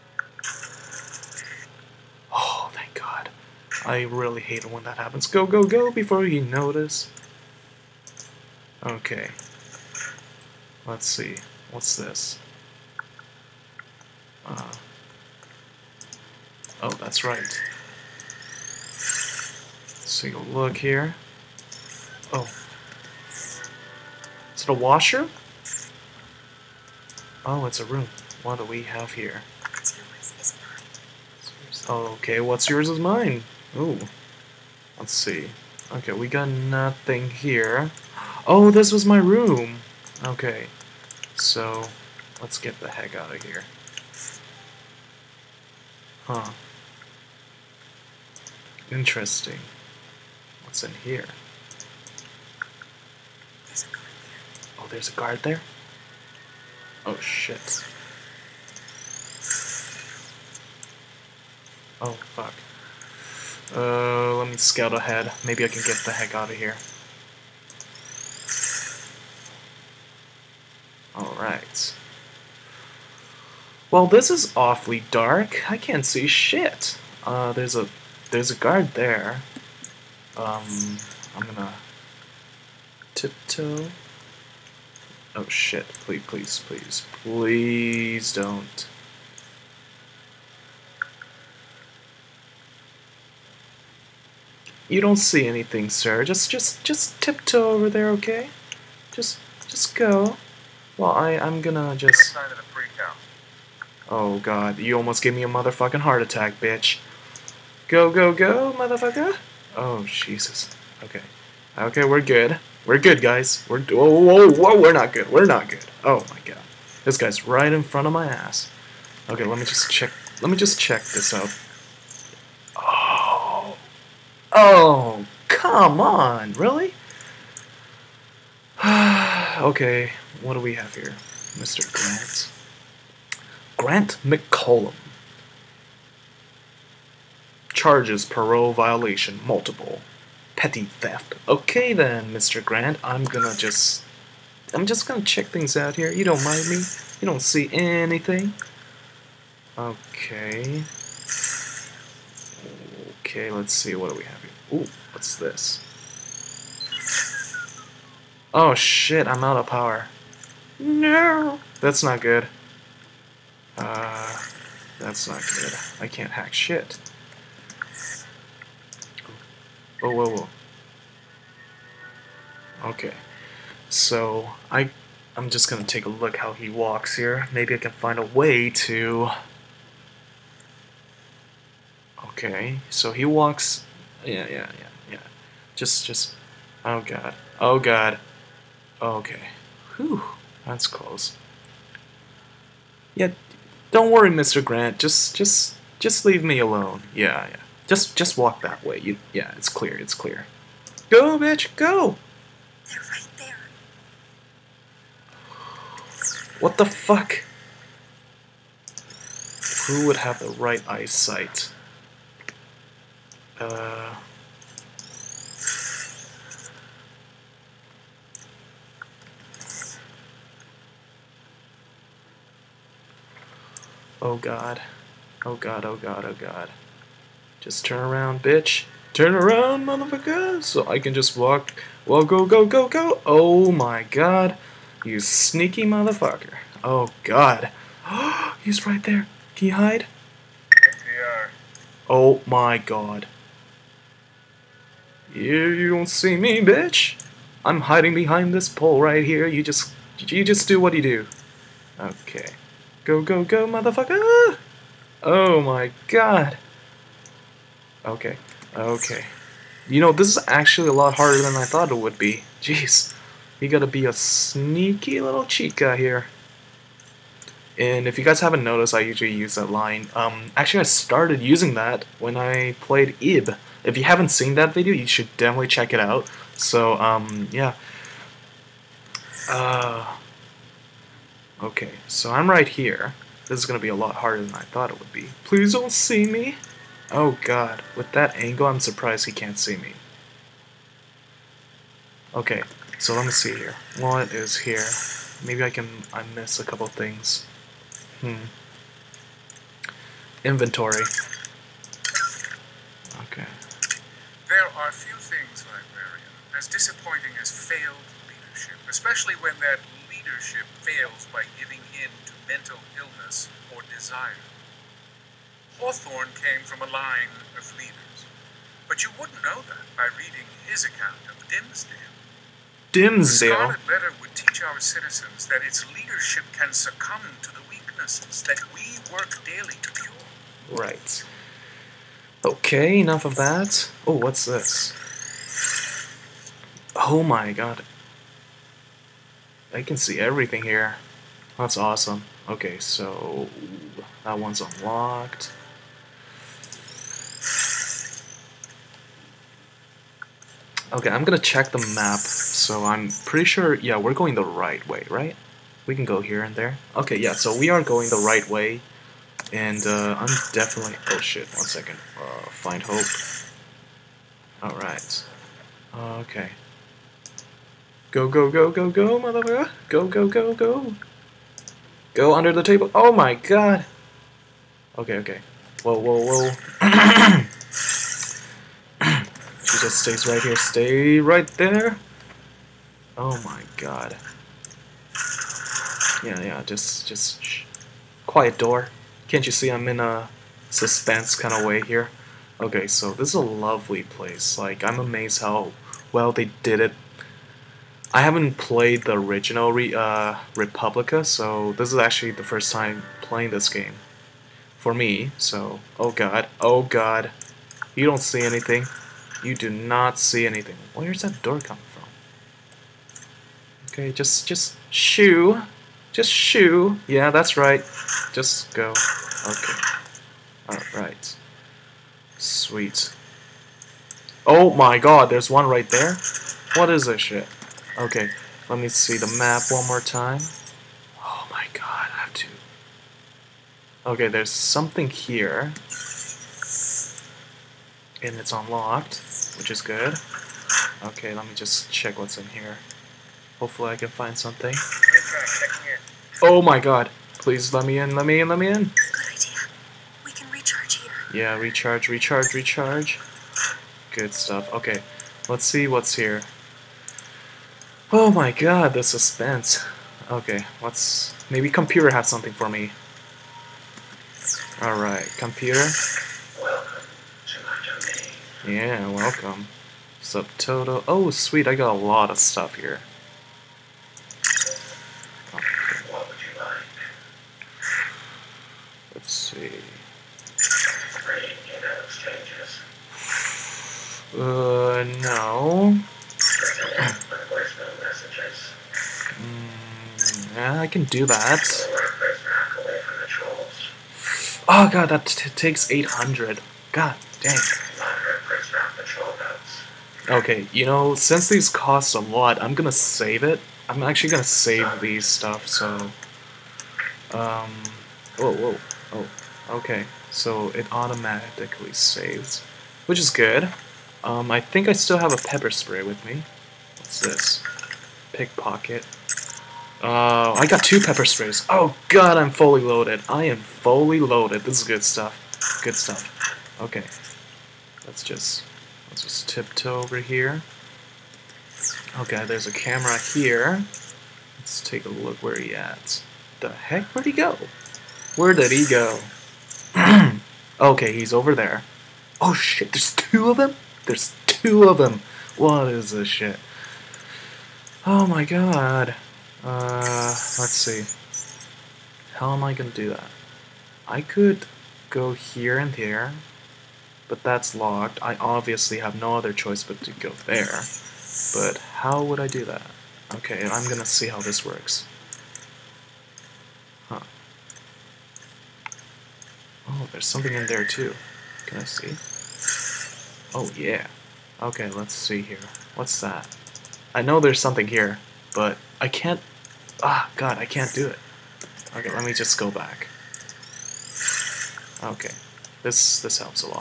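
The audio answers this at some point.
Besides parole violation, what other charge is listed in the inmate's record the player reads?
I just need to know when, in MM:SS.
02:20.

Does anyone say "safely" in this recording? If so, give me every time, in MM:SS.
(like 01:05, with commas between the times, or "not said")
not said.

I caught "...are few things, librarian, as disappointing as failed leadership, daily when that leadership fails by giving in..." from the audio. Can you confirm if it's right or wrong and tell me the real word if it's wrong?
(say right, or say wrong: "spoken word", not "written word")
wrong: "especially", not "daily".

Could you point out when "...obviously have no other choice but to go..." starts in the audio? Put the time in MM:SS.
09:18.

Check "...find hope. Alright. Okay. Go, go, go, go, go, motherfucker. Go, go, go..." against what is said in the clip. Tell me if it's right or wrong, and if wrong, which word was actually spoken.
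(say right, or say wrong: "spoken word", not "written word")
right.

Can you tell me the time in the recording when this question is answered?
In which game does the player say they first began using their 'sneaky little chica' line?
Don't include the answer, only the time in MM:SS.
04:33.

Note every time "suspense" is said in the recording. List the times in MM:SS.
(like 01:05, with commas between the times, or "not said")
06:30, 07:39.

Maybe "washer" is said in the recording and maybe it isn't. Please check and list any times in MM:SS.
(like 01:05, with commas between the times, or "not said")
00:24.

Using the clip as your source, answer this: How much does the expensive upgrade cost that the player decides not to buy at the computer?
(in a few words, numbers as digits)
800.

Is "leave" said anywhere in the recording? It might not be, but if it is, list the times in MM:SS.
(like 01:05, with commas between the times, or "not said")
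03:16.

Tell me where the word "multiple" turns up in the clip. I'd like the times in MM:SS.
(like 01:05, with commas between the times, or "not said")
02:19.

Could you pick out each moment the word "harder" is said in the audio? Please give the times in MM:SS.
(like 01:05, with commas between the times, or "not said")
04:21, 04:44.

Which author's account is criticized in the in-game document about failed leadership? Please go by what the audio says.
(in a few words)
Hawthorne.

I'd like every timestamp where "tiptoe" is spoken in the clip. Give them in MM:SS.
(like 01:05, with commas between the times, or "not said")
01:23, 01:37, 08:49.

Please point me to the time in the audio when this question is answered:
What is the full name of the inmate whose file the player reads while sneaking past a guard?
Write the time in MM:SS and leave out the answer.
02:13.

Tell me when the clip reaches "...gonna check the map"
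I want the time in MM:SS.
05:51.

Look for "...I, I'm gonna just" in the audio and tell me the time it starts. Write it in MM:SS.
01:41.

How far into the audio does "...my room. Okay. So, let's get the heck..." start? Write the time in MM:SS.
00:39.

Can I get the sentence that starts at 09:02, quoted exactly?
Oh shit, there's two of them?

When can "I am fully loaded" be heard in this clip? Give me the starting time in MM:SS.
08:43.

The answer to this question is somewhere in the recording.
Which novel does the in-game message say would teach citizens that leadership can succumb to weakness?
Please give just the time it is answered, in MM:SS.
05:23.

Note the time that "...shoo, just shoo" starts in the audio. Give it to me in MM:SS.
06:54.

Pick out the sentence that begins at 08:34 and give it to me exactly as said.
Um, I think I still have a pepper spray with me.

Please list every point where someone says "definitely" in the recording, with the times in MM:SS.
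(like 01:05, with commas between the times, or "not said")
04:35, 06:00.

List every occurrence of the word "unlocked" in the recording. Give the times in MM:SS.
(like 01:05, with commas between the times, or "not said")
05:44, 07:18.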